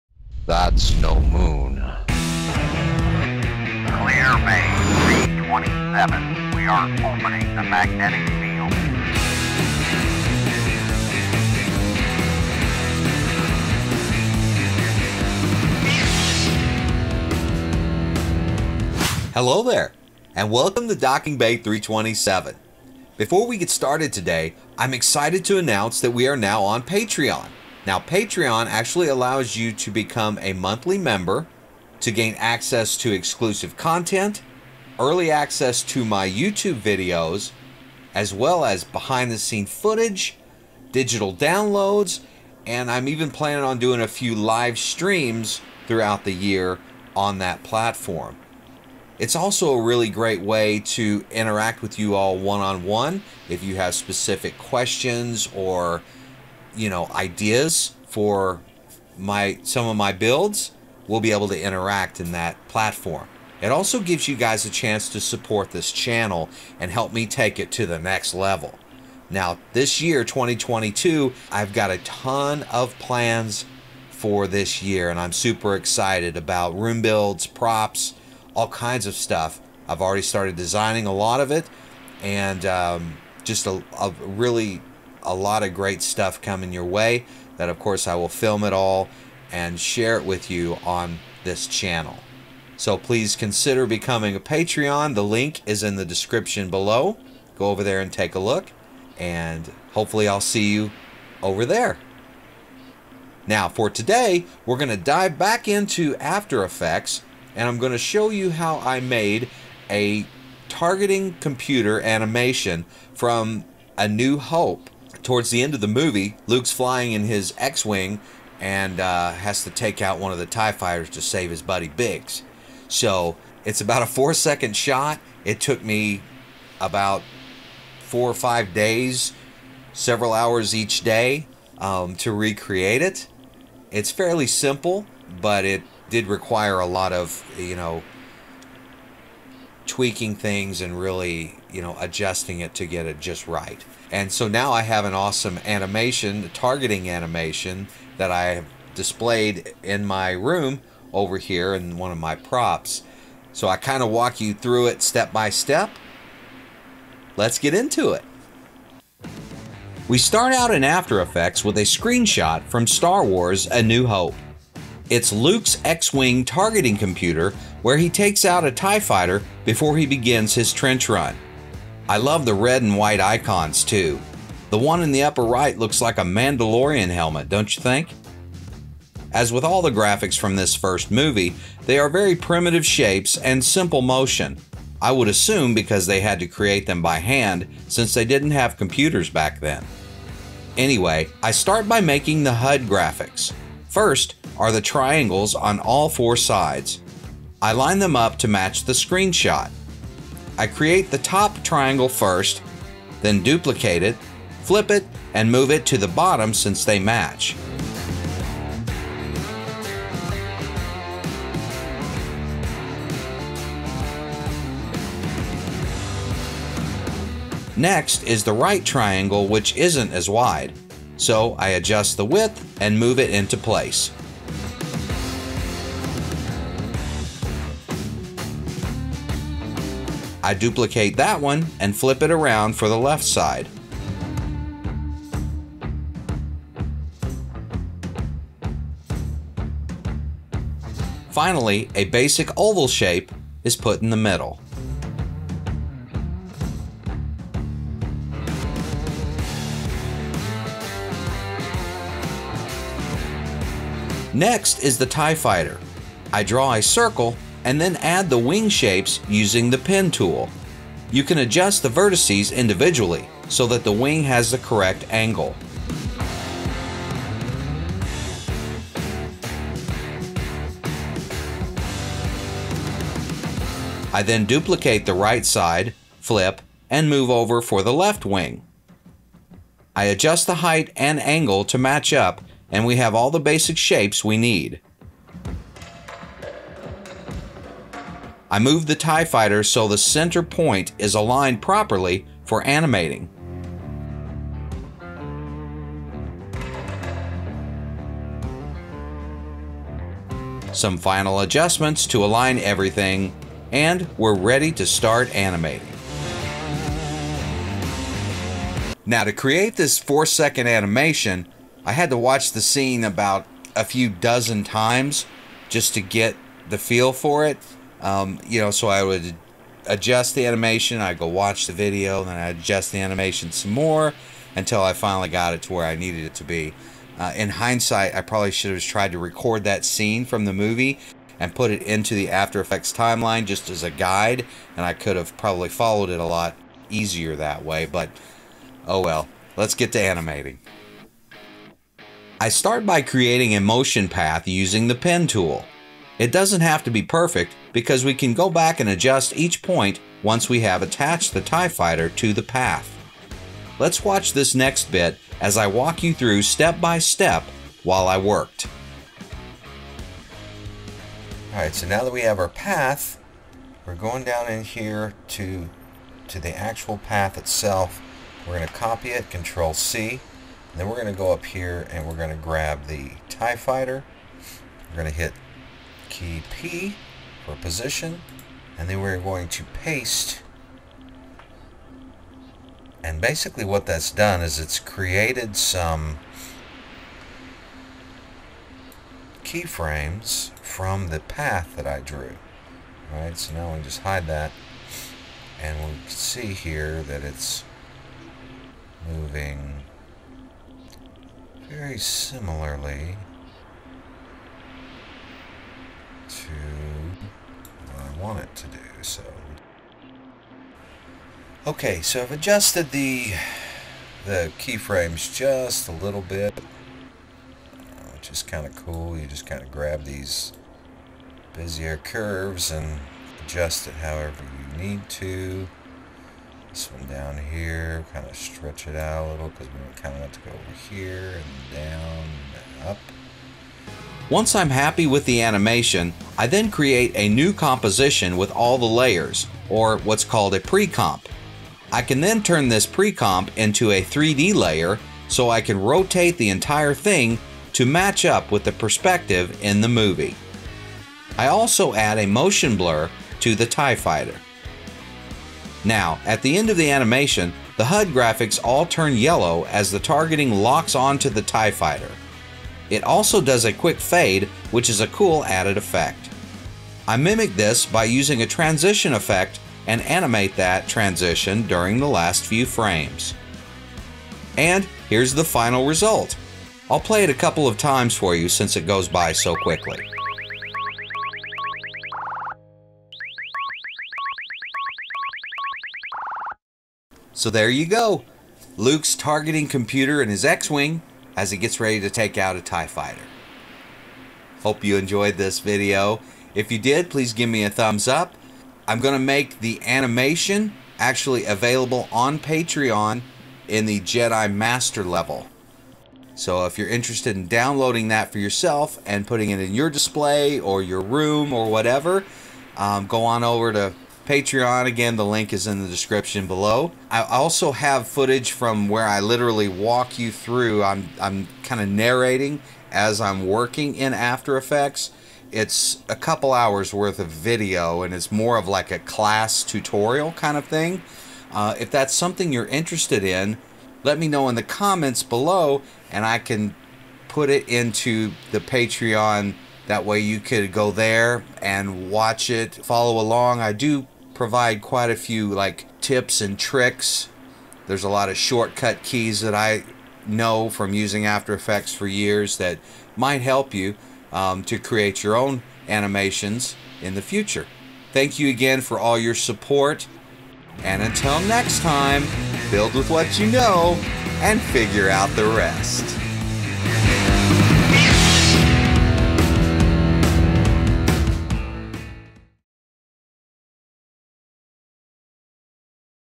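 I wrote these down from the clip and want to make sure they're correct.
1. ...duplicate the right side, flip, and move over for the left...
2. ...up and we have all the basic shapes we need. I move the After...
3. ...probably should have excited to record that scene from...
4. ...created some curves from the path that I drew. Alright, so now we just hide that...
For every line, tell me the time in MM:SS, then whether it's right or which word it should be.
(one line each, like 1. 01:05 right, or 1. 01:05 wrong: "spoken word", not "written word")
1. 04:34 right
2. 04:42 wrong: "TIE", not "After"
3. 05:28 wrong: "tried", not "excited"
4. 06:24 wrong: "keyframes", not "curves".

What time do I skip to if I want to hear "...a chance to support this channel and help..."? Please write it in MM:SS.
01:04.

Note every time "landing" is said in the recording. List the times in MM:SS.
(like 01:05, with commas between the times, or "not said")
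not said.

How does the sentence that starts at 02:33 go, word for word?
So I kind of walk you through it step by step.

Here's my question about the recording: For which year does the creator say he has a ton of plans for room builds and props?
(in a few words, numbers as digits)
2022.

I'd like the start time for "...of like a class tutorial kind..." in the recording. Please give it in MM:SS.
08:48.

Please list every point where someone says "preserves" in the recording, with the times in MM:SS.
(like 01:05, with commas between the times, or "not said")
not said.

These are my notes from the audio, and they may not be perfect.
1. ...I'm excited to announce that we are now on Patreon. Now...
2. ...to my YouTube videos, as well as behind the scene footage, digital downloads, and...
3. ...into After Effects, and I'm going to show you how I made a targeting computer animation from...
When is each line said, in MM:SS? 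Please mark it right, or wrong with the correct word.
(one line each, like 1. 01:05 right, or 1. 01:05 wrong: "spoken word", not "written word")
1. 00:24 right
2. 00:35 right
3. 01:45 right.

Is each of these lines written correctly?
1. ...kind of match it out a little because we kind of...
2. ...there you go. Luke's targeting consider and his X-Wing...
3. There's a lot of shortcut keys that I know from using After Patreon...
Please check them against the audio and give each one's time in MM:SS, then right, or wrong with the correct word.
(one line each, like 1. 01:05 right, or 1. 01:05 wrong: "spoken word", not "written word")
1. 07:08 wrong: "stretch", not "match"
2. 08:07 wrong: "computer", not "consider"
3. 09:07 wrong: "Effects", not "Patreon".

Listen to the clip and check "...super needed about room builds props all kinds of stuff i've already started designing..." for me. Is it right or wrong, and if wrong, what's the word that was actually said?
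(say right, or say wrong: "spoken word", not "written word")
wrong: "excited", not "needed".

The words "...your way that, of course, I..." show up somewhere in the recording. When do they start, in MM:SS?
01:26.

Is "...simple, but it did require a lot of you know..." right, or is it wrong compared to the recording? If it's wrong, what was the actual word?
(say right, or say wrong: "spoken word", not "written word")
right.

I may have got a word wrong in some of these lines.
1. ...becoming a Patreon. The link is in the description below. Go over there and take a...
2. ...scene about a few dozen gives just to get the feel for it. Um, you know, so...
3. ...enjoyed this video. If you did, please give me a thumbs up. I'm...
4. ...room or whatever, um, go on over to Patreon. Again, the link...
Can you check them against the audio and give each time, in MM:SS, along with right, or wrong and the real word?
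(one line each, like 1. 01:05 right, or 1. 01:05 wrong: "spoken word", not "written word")
1. 01:33 right
2. 05:12 wrong: "times", not "gives"
3. 08:14 right
4. 08:31 right.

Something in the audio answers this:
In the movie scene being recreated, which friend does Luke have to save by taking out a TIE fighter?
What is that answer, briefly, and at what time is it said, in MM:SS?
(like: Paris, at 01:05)
Biggs, at 02:01.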